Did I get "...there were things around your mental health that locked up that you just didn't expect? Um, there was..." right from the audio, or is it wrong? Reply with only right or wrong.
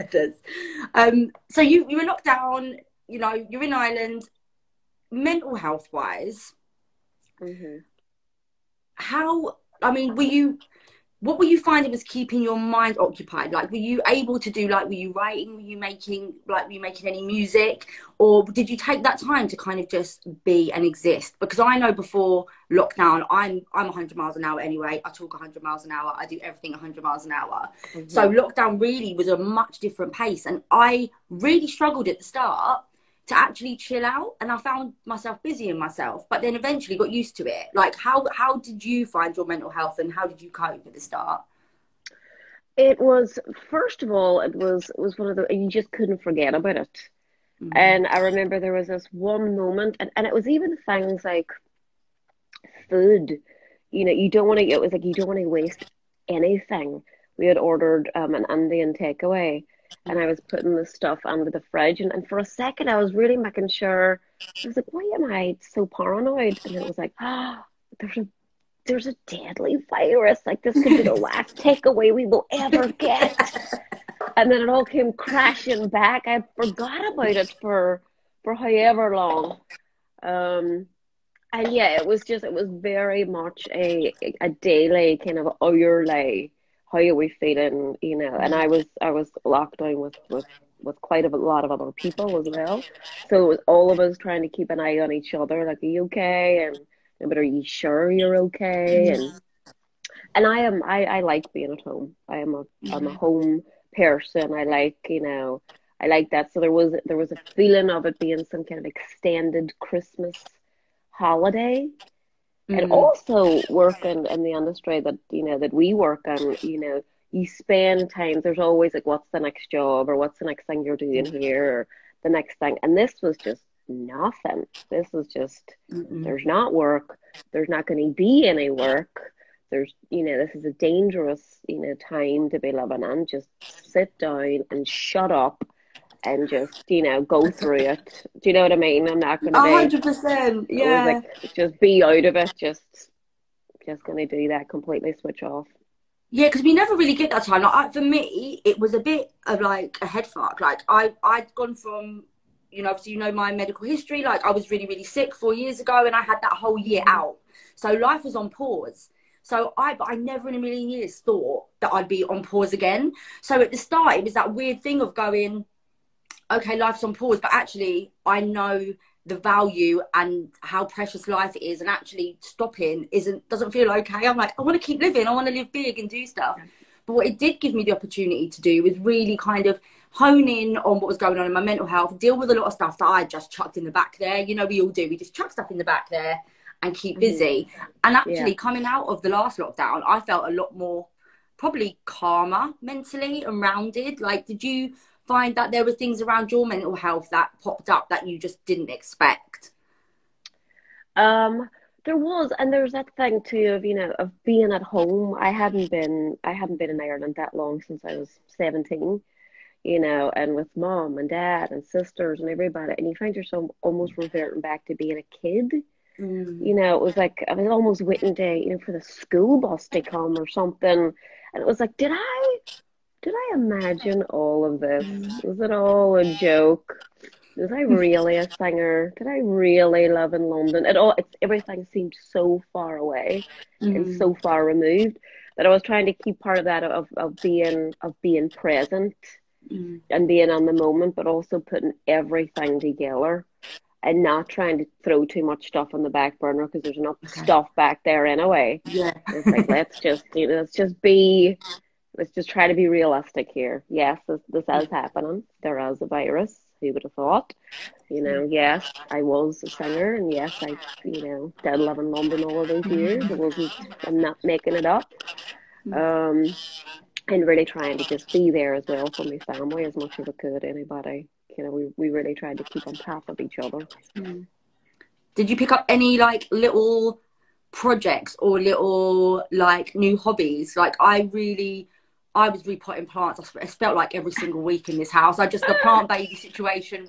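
wrong.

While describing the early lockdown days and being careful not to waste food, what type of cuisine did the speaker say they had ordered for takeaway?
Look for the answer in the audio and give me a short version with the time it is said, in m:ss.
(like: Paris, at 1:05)
Indian, at 0:58.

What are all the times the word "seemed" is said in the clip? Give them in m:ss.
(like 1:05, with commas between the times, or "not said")
3:51.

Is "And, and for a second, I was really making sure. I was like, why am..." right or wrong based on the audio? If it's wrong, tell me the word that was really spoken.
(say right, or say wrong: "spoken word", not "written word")
right.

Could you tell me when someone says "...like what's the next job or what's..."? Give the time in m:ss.
1:58.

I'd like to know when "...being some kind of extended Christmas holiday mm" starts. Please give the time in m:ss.
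1:48.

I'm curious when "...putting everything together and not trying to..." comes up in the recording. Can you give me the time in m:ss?
4:01.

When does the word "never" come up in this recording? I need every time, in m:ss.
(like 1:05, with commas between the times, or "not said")
2:26, 2:40.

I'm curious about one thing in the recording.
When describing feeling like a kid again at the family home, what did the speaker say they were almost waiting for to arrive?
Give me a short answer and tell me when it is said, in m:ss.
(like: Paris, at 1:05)
school bus, at 3:39.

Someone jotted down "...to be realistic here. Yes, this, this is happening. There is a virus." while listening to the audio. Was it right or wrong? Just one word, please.
right.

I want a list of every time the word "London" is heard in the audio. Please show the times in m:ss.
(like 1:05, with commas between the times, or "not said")
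3:50, 4:22.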